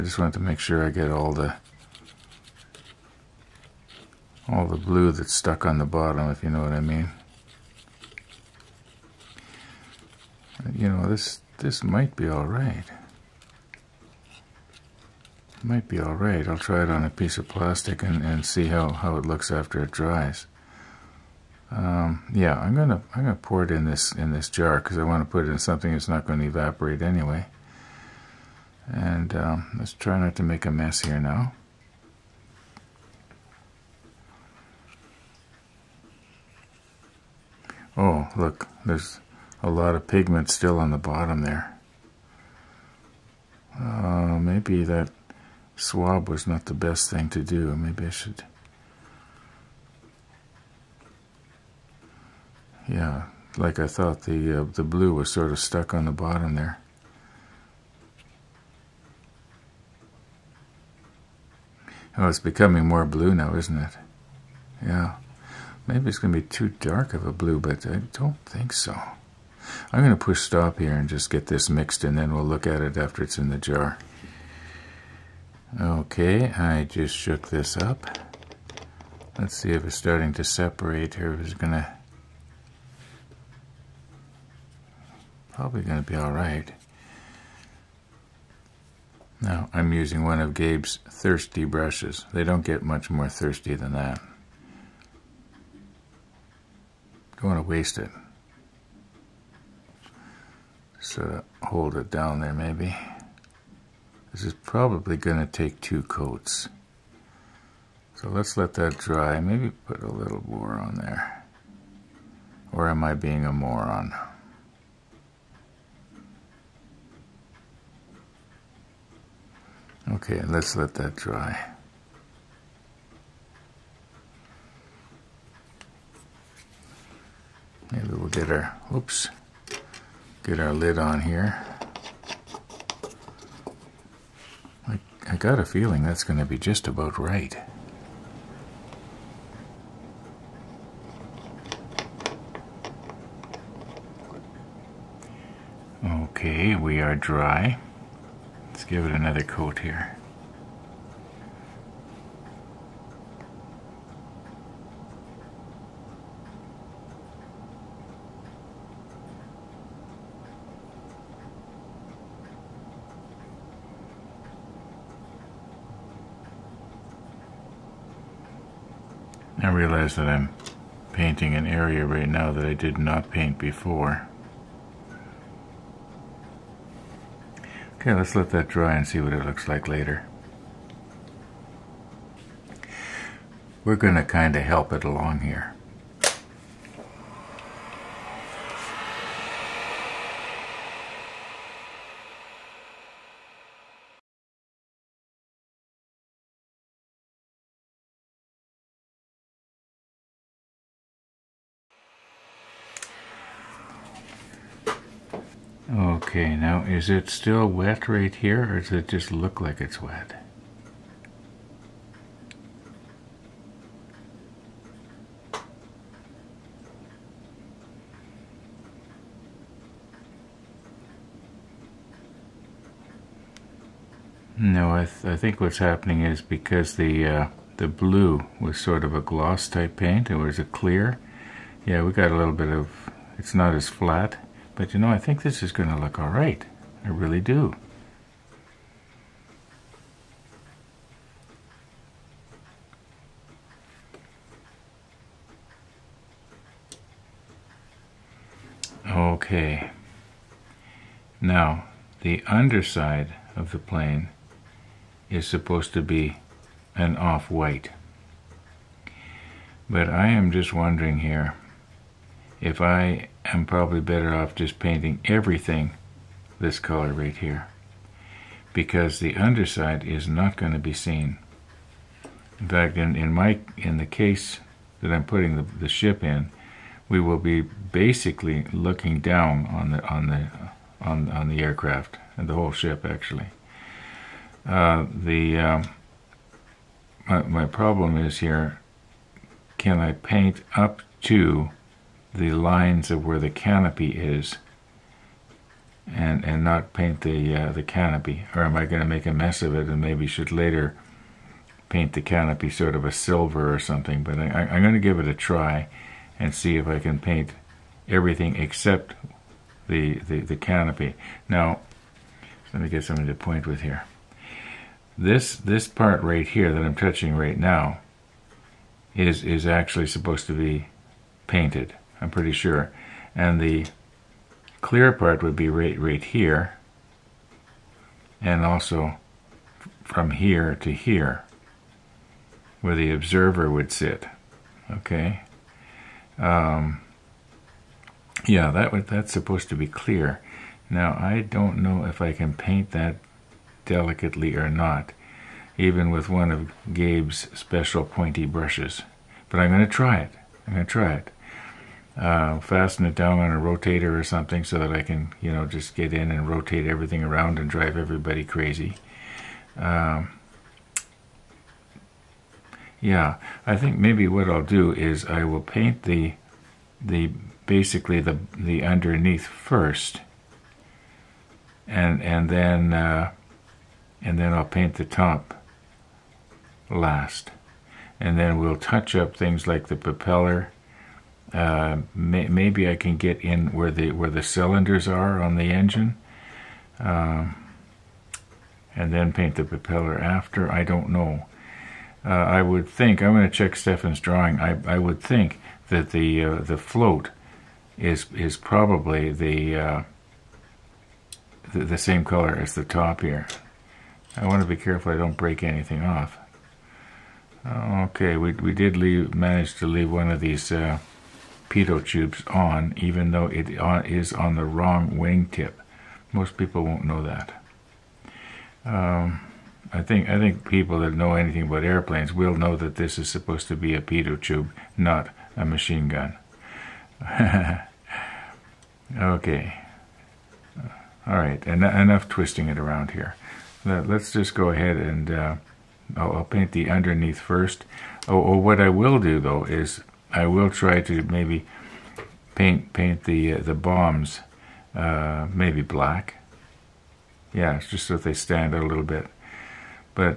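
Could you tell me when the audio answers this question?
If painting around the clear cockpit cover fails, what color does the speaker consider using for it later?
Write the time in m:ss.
5:03.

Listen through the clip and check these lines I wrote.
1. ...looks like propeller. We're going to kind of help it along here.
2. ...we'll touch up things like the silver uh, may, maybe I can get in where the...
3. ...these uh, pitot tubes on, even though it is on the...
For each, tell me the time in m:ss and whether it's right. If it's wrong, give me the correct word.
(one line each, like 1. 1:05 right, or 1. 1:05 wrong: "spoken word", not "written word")
1. 2:59 wrong: "later", not "propeller"
2. 6:18 wrong: "propeller", not "silver"
3. 6:50 right.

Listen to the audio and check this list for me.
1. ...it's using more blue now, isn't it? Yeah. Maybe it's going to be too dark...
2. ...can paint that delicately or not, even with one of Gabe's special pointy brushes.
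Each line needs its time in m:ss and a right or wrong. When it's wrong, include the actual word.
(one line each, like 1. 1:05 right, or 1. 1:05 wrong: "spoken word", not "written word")
1. 1:02 wrong: "becoming", not "using"
2. 5:42 right.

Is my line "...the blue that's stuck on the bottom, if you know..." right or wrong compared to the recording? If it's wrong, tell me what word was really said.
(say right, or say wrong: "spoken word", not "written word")
right.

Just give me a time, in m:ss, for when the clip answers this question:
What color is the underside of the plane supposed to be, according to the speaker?
4:17.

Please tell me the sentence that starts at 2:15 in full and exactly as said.
I got a feeling that's going to be just about right.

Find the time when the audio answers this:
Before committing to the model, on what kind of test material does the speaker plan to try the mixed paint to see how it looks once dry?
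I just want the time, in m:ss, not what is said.
0:17.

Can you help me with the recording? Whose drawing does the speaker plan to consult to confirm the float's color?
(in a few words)
Stefan's.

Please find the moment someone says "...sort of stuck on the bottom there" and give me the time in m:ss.
0:55.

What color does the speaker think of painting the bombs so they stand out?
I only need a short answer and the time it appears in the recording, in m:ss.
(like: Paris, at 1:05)
black, at 7:25.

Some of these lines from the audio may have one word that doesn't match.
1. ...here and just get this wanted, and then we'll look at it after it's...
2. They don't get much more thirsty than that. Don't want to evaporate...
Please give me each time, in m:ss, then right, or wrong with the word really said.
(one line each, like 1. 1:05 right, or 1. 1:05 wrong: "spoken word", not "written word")
1. 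1:10 wrong: "mixed", not "wanted"
2. 1:32 wrong: "waste", not "evaporate".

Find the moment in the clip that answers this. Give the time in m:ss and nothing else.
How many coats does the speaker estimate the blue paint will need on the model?
1:45.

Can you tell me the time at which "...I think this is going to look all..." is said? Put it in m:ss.
3:55.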